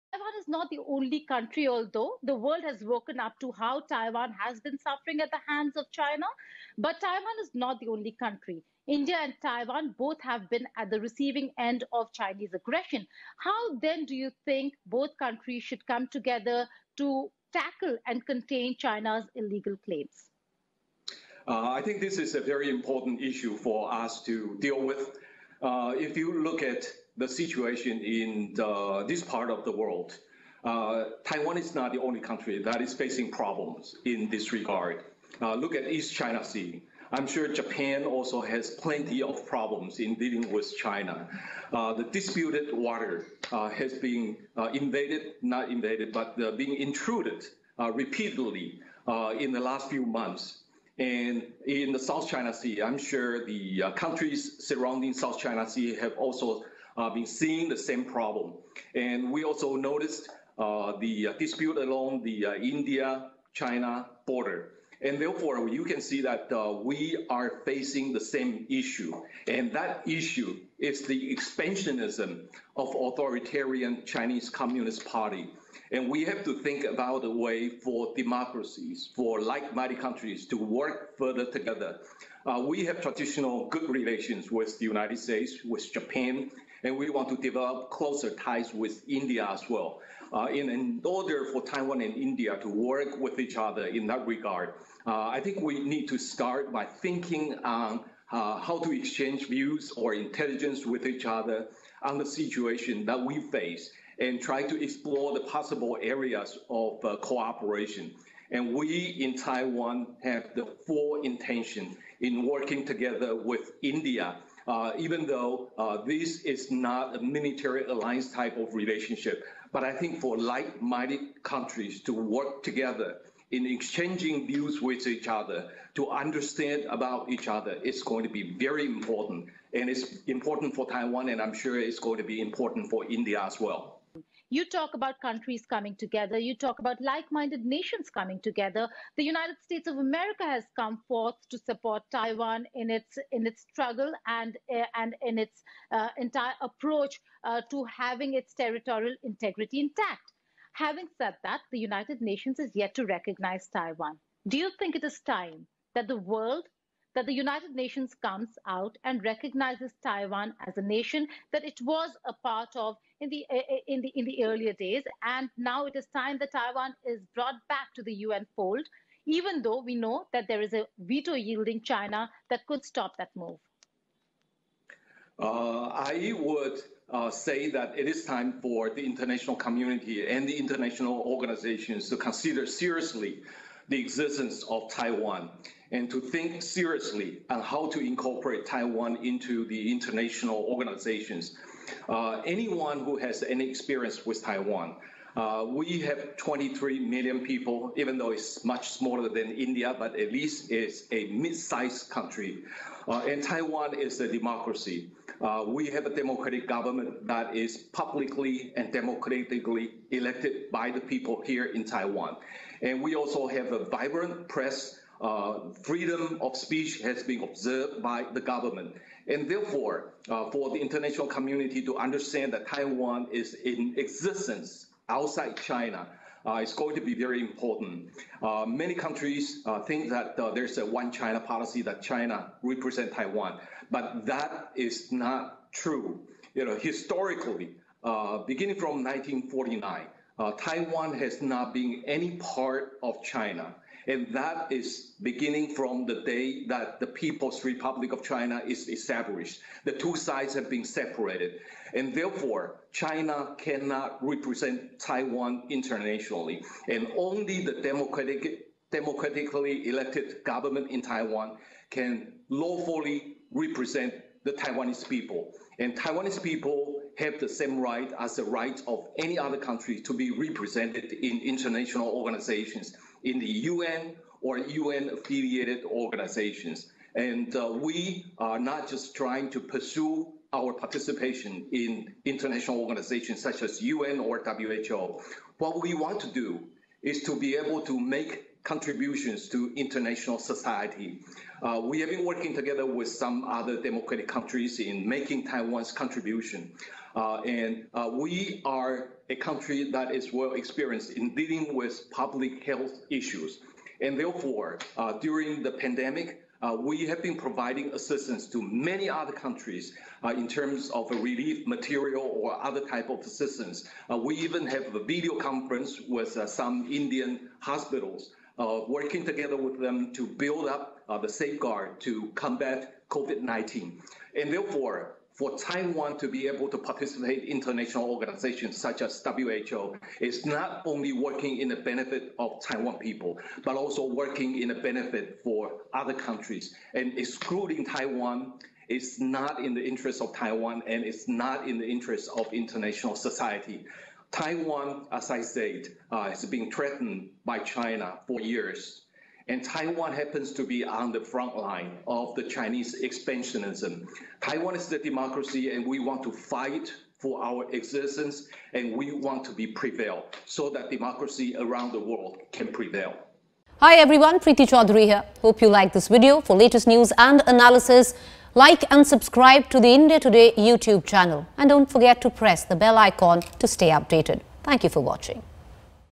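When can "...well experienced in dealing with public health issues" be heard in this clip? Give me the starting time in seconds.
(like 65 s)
300 s.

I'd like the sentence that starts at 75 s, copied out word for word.
And we have to think about a way for democracies, for like-minded countries to work further together.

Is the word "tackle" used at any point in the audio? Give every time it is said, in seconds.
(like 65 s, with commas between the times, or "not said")
17 s.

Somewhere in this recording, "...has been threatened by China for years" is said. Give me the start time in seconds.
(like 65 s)
346 s.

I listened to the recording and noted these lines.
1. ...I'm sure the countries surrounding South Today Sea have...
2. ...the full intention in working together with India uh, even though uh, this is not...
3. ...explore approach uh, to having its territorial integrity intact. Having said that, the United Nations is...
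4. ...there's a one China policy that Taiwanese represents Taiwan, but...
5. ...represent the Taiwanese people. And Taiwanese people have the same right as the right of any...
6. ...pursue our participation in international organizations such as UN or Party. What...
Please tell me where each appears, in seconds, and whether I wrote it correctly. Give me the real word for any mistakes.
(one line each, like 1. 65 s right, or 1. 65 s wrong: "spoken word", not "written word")
1. 52 s wrong: "China", not "Today"
2. 110 s right
3. 146 s wrong: "entire", not "explore"
4. 230 s wrong: "China", not "Taiwanese"
5. 263 s right
6. 279 s wrong: "WHO", not "Party".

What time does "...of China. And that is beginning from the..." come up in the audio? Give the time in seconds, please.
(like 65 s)
243 s.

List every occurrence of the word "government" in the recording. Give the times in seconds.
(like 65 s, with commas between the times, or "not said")
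206 s, 218 s, 260 s.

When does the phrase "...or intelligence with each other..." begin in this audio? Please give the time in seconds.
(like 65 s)
99 s.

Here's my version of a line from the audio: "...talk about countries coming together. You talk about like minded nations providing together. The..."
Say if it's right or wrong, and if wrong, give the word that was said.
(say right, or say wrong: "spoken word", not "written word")
wrong: "coming", not "providing".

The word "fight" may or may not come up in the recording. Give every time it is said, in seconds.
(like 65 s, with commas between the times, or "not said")
356 s.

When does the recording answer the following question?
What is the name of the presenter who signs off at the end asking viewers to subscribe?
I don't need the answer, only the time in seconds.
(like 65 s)
364 s.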